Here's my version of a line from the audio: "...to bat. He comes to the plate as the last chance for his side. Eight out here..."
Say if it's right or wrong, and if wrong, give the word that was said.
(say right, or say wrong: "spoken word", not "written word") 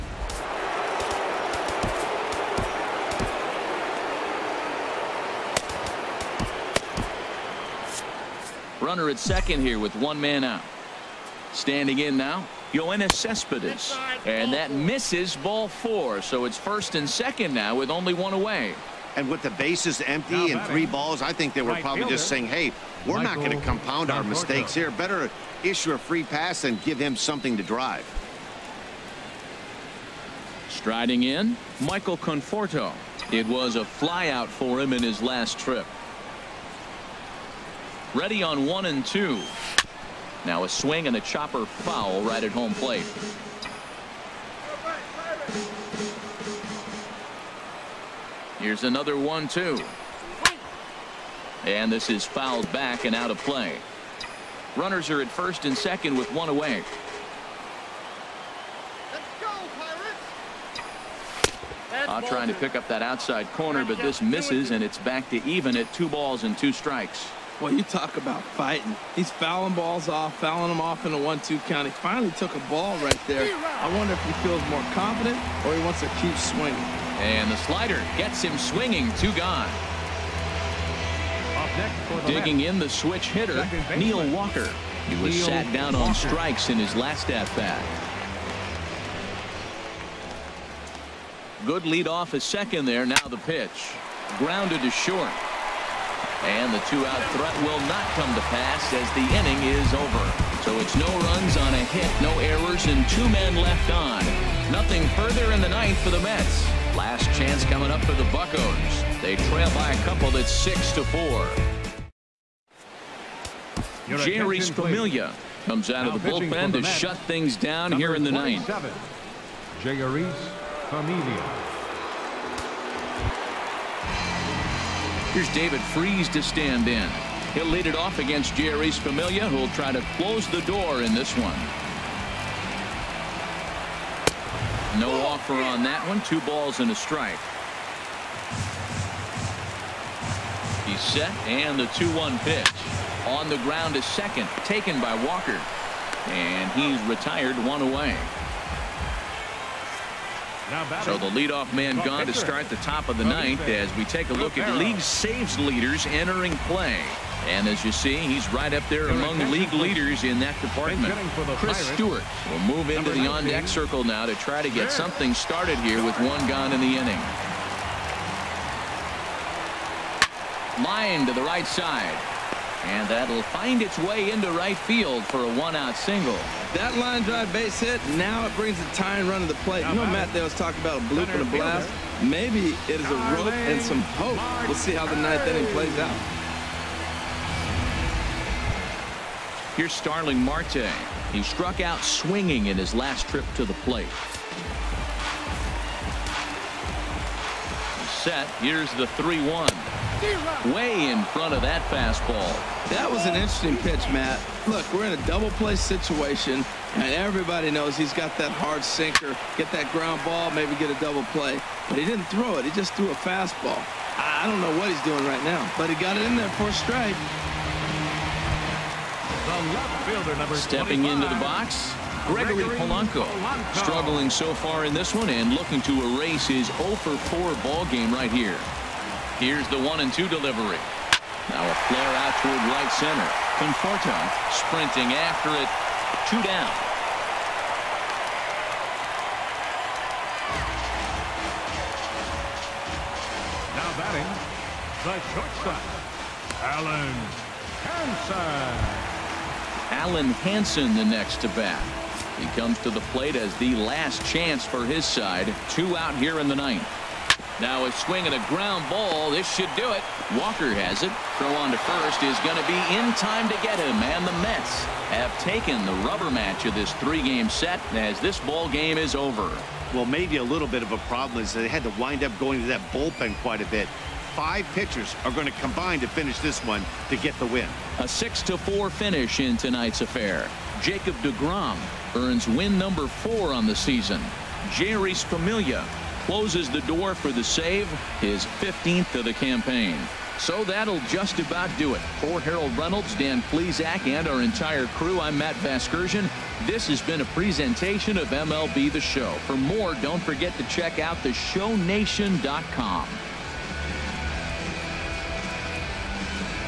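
wrong: "Two", not "Eight".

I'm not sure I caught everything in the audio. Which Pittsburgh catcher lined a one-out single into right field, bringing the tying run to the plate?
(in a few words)
Chris Stewart.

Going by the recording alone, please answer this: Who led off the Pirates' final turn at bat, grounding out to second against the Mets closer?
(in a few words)
David Freese.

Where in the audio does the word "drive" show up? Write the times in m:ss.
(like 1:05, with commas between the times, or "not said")
0:27, 2:57.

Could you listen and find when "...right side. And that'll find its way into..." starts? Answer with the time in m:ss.
2:51.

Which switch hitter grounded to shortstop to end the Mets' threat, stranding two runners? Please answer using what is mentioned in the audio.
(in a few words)
Neil Walker.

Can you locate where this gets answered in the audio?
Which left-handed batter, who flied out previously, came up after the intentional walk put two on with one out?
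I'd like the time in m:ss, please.
0:31.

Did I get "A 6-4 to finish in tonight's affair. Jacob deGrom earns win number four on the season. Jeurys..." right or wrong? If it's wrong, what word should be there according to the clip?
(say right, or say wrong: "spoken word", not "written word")
right.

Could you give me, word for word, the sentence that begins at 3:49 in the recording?
Here's the one and two delivery.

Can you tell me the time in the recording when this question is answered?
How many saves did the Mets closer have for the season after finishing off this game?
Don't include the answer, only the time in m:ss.
4:48.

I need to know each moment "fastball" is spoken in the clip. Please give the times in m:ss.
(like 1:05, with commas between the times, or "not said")
3:21, 3:33.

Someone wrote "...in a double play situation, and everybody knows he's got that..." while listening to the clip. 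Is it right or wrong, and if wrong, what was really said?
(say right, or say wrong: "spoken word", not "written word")
right.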